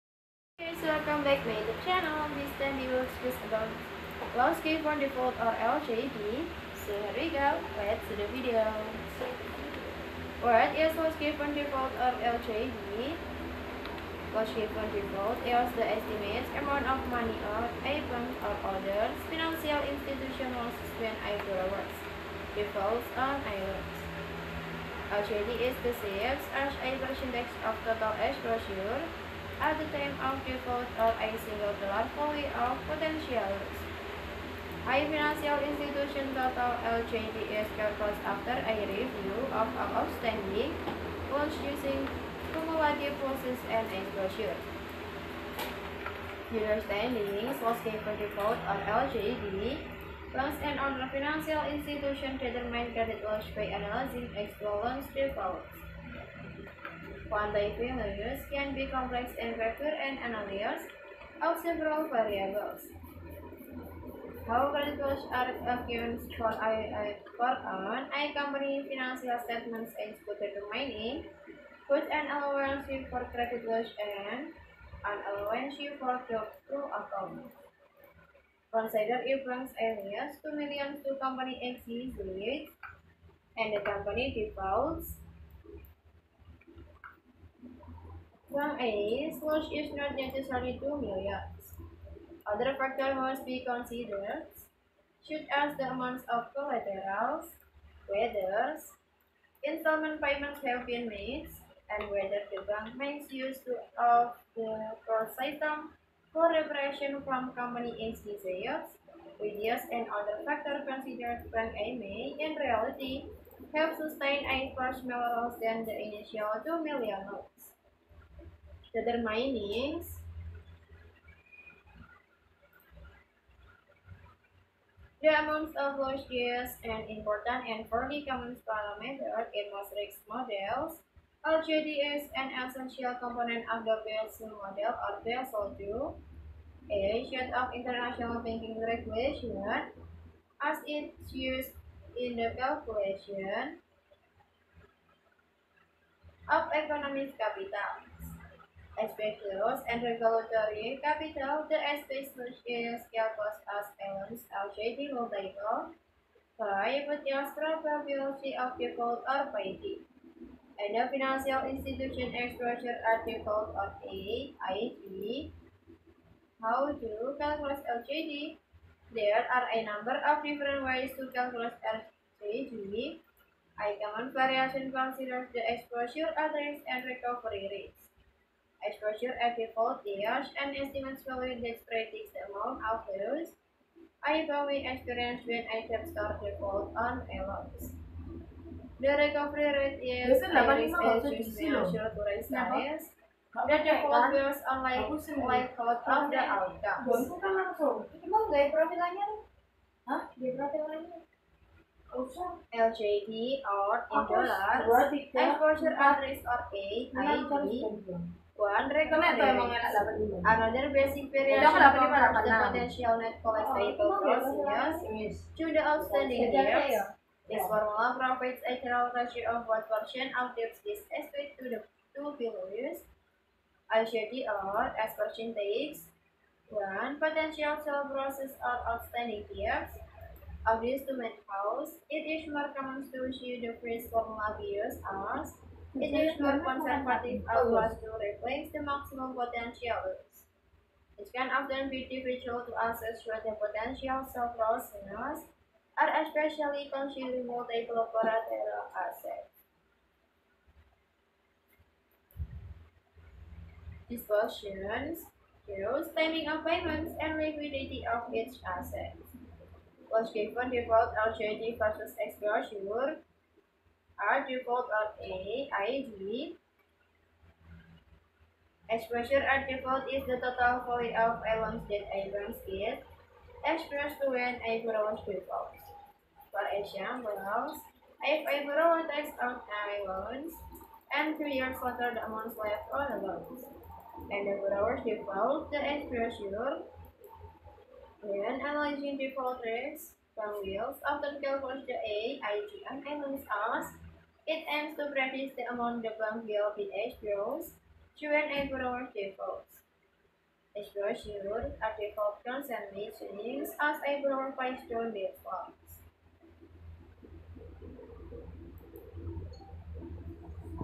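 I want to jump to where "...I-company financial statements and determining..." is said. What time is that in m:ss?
1:08.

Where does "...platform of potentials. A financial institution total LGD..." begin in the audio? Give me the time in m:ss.
0:31.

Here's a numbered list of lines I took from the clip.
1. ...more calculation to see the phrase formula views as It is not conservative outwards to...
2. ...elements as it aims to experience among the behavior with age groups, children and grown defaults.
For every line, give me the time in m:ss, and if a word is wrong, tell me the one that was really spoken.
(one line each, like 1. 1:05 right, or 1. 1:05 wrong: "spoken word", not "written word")
1. 3:52 wrong: "common", not "calculation"
2. 4:53 wrong: "practice", not "experience".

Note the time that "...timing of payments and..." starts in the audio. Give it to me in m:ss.
4:16.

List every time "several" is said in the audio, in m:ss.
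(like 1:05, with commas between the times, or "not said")
1:01, 4:04.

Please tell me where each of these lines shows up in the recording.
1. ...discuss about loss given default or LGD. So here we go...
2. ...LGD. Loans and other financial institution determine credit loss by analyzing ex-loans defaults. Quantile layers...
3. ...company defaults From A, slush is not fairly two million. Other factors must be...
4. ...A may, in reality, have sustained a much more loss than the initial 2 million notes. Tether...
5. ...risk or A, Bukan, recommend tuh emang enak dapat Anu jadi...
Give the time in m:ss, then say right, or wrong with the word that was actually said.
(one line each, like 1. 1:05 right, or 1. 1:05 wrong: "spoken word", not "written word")
1. 0:03 right
2. 0:49 right
3. 1:23 wrong: "necessarily", not "fairly"
4. 1:51 right
5. 3:26 right.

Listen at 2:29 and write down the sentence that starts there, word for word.
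Espectadores and regulatory capital de scale que as elements outdating of the prior with the probability of default or paying.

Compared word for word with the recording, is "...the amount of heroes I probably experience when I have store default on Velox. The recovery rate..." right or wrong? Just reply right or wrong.
right.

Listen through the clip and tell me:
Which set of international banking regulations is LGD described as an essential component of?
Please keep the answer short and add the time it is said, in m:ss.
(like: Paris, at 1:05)
Basel 2, at 2:15.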